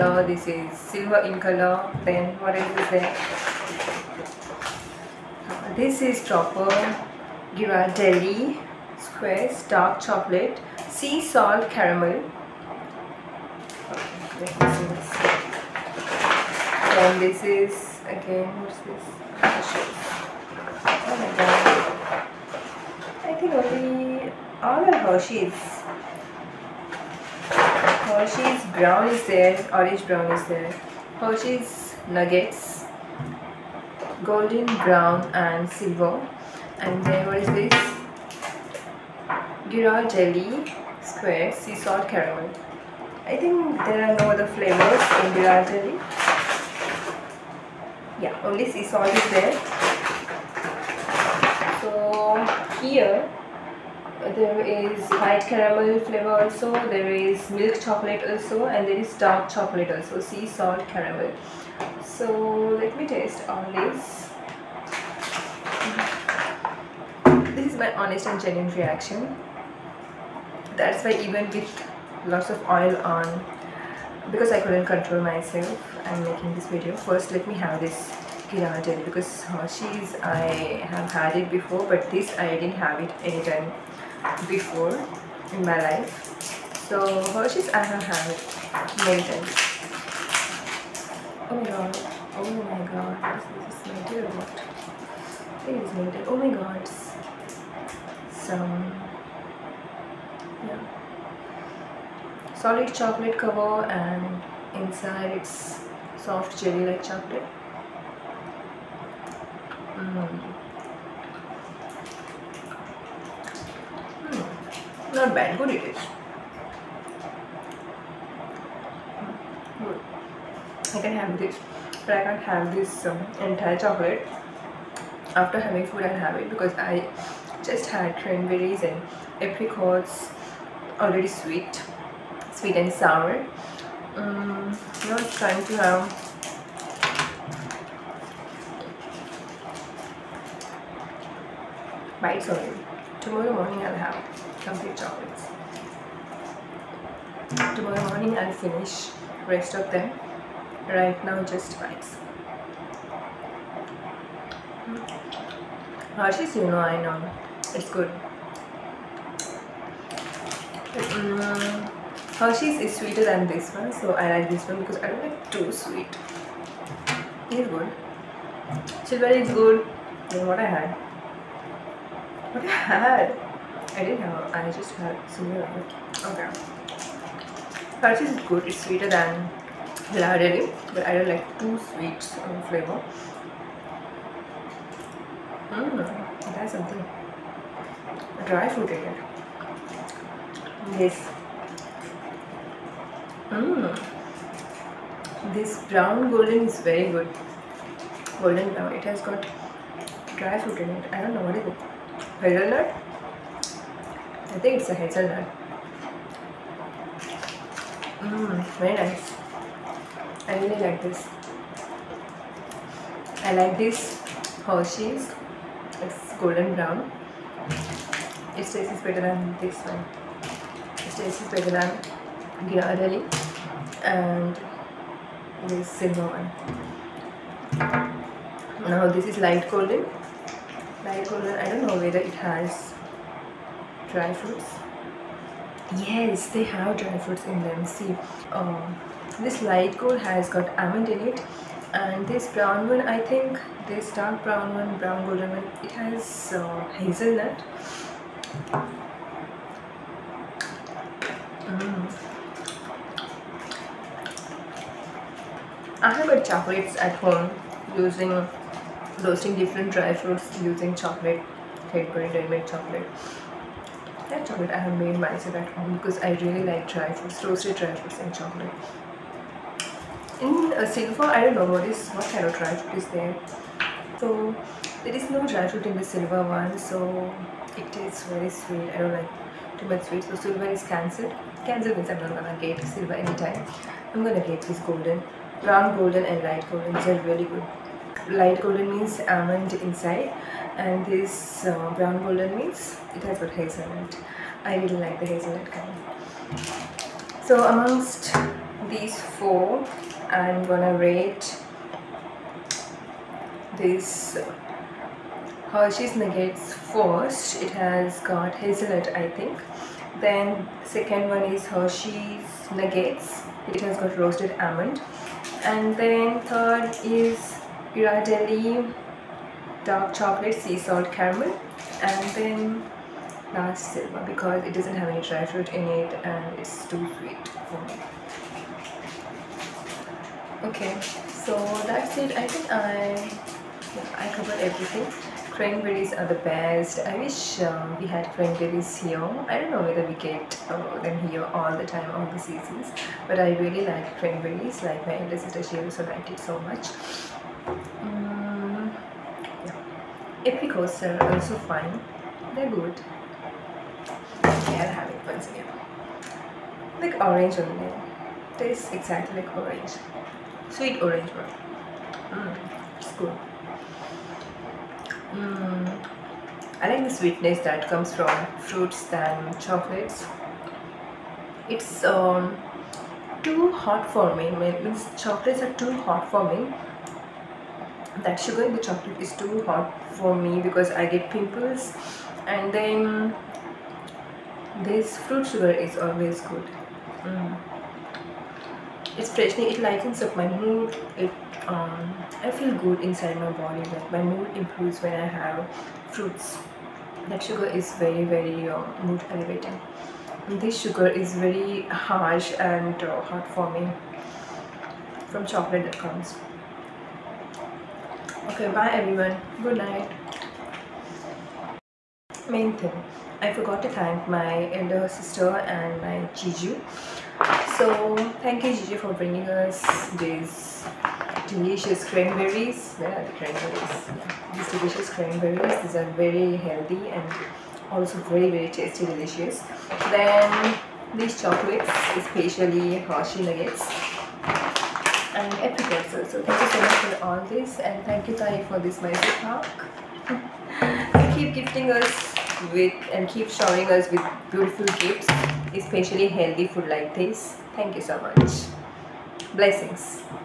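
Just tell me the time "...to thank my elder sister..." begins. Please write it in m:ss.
6:53.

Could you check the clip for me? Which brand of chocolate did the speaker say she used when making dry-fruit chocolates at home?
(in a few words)
Cadbury.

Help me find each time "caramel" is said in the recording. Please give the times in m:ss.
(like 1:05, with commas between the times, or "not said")
0:11, 0:42, 0:55, 1:00, 5:21.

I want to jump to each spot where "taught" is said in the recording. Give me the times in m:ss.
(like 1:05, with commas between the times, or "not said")
not said.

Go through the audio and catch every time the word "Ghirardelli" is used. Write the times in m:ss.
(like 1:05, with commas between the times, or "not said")
0:07, 0:39, 0:45, 1:18, 3:42, 5:17.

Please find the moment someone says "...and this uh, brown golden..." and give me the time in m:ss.
4:50.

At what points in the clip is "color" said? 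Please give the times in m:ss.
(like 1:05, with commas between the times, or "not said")
0:01, 4:55.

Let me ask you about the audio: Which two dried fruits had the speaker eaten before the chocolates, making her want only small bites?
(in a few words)
Cranberries and apricots.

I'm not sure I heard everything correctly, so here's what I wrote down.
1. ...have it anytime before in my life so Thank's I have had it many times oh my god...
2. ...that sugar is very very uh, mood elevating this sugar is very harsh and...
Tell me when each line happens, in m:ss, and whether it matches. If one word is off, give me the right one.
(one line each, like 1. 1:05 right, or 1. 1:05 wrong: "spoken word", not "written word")
1. 1:22 wrong: "Hershey", not "Thank"
2. 6:37 right.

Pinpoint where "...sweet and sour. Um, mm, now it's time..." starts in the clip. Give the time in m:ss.
2:12.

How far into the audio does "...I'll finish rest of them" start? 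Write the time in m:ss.
2:28.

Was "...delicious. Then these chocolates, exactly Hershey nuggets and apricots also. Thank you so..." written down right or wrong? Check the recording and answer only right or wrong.
wrong.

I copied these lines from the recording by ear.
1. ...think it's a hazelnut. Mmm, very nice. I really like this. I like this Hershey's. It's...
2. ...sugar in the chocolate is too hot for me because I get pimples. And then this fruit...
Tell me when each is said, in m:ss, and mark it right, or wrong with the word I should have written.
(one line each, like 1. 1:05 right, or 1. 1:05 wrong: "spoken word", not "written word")
1. 3:24 right
2. 6:18 right.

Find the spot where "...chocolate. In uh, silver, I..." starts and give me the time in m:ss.
4:28.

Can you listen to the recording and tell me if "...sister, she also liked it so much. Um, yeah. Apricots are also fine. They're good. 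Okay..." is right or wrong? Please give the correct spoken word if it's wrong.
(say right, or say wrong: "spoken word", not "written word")
right.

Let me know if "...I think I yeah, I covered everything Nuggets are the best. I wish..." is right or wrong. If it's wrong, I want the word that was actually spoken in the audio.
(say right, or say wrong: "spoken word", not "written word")
wrong: "Cranberries", not "Nuggets".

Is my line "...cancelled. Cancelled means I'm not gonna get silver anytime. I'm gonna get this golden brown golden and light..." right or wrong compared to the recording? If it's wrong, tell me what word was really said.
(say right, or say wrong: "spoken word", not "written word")
right.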